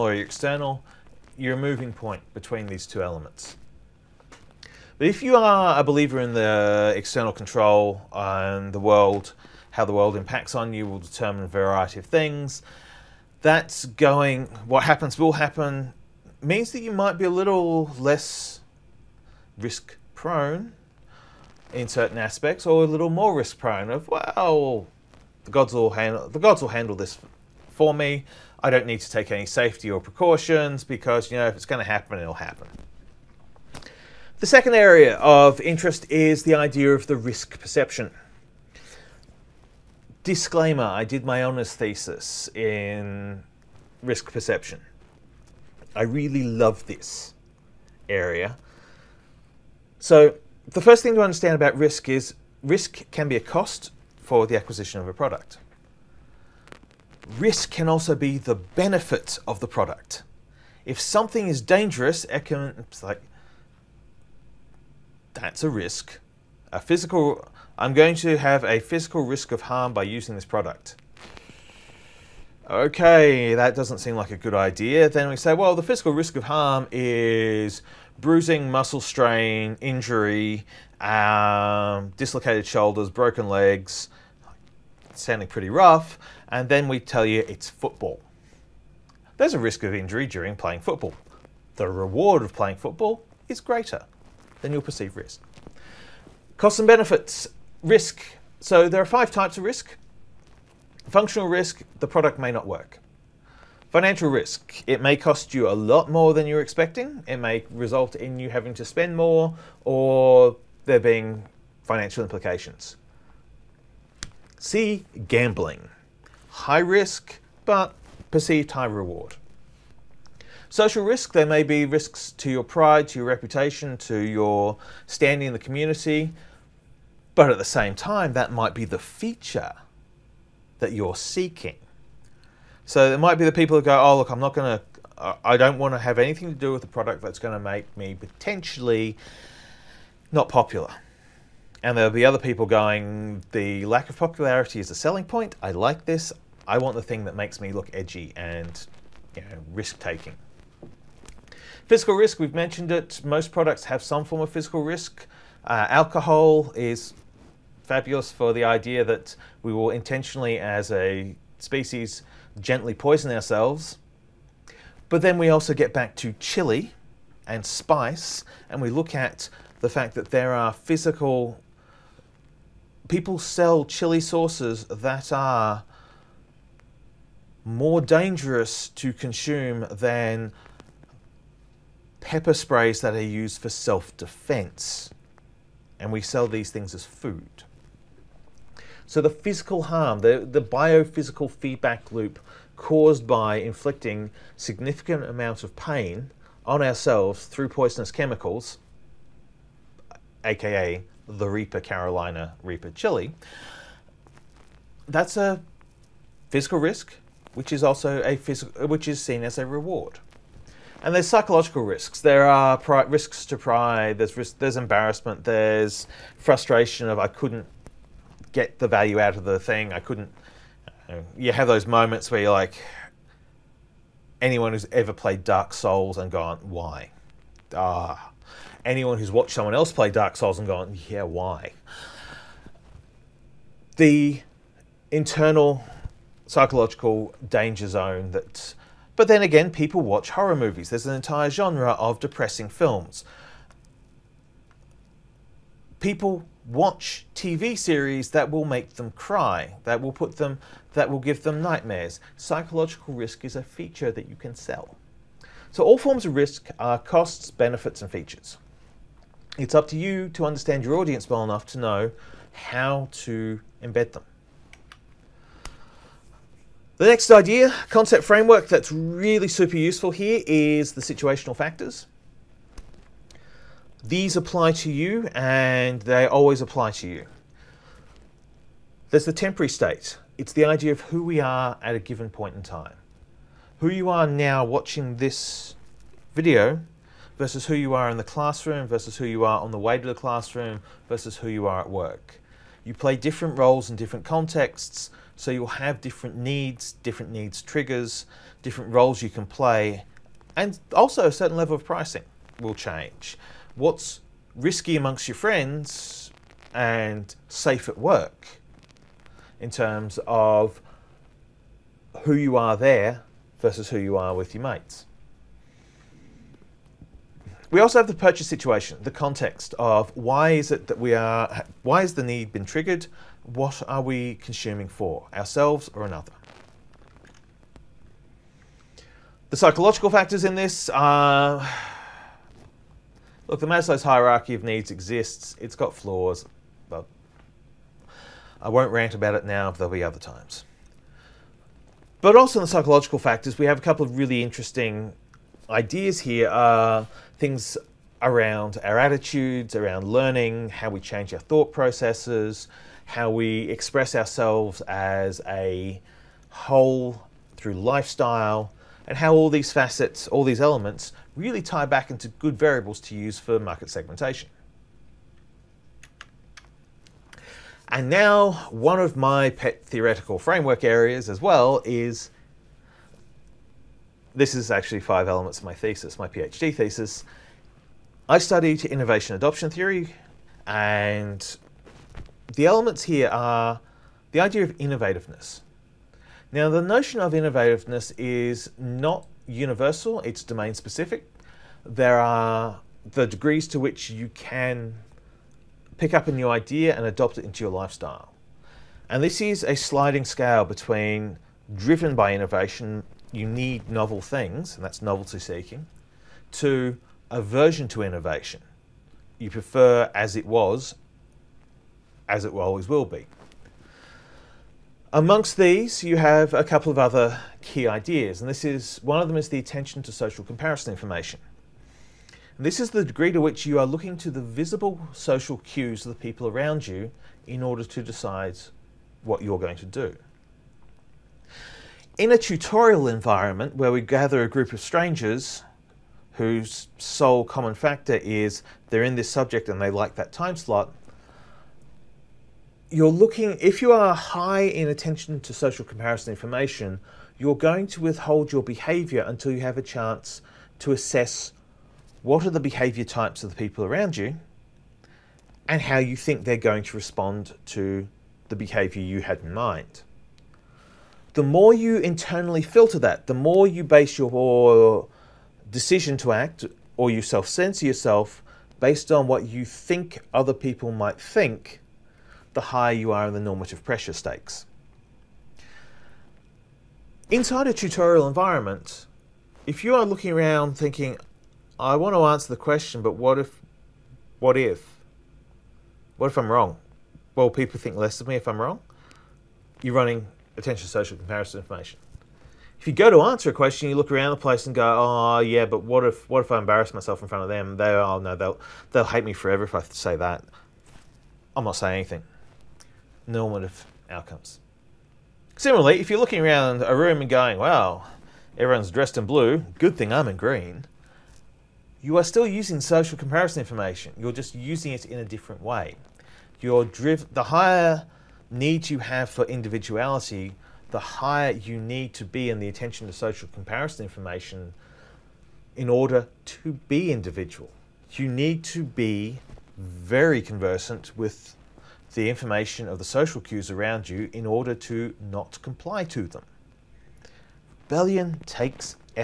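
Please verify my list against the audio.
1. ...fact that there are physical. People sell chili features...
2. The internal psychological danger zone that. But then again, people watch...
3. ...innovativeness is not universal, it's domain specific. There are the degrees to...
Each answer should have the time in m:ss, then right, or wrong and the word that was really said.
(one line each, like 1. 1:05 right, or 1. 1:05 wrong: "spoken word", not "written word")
1. 2:49 wrong: "sauces", not "features"
2. 3:53 right
3. 6:27 right.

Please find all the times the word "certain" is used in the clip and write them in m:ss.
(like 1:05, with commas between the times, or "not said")
0:21, 5:01.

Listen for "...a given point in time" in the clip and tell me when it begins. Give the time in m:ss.
4:41.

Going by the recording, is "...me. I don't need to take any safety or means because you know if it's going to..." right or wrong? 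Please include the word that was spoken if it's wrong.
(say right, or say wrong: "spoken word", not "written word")
wrong: "precautions", not "means".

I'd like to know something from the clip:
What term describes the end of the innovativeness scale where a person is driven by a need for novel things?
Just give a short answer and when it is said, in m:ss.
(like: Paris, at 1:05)
Novelty seeking, at 6:45.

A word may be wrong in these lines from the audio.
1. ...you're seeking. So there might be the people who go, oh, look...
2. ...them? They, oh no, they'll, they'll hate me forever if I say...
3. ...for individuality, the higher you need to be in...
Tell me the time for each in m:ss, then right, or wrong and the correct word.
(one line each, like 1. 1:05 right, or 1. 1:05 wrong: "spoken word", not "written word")
1. 2:10 right
2. 8:17 right
3. 8:39 right.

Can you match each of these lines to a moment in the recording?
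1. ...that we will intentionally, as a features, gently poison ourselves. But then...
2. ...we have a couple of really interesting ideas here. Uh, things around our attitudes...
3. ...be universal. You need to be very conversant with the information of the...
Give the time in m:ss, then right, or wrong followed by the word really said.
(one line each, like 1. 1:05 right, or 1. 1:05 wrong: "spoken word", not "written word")
1. 2:39 wrong: "species", not "features"
2. 5:43 right
3. 8:46 wrong: "individual", not "universal".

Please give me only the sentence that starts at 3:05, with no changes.
And we sell these things as food.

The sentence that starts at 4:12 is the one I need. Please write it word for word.
Psychological risk is a feature that you can sell.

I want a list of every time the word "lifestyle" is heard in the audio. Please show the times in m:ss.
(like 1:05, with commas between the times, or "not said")
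5:57, 6:37.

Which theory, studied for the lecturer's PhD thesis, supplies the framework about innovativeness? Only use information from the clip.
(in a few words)
Innovation adoption theory.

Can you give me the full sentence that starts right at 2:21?
And there'll be other people going, the lack of popularity is a selling point.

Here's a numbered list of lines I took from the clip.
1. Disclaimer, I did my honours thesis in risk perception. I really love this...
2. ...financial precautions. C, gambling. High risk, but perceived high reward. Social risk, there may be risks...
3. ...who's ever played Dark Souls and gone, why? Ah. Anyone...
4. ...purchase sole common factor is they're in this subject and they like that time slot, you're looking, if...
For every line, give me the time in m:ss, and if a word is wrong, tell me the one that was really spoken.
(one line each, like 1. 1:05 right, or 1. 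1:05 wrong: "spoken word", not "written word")
1. 0:40 right
2. 1:51 wrong: "implications", not "precautions"
3. 3:44 right
4. 7:16 wrong: "whose", not "purchase".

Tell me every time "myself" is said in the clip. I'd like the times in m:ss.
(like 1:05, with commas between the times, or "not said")
8:16.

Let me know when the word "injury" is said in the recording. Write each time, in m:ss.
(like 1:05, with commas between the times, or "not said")
1:19, 1:29.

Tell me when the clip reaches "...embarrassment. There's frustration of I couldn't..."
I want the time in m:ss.
3:34.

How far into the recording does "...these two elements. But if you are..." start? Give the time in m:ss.
0:02.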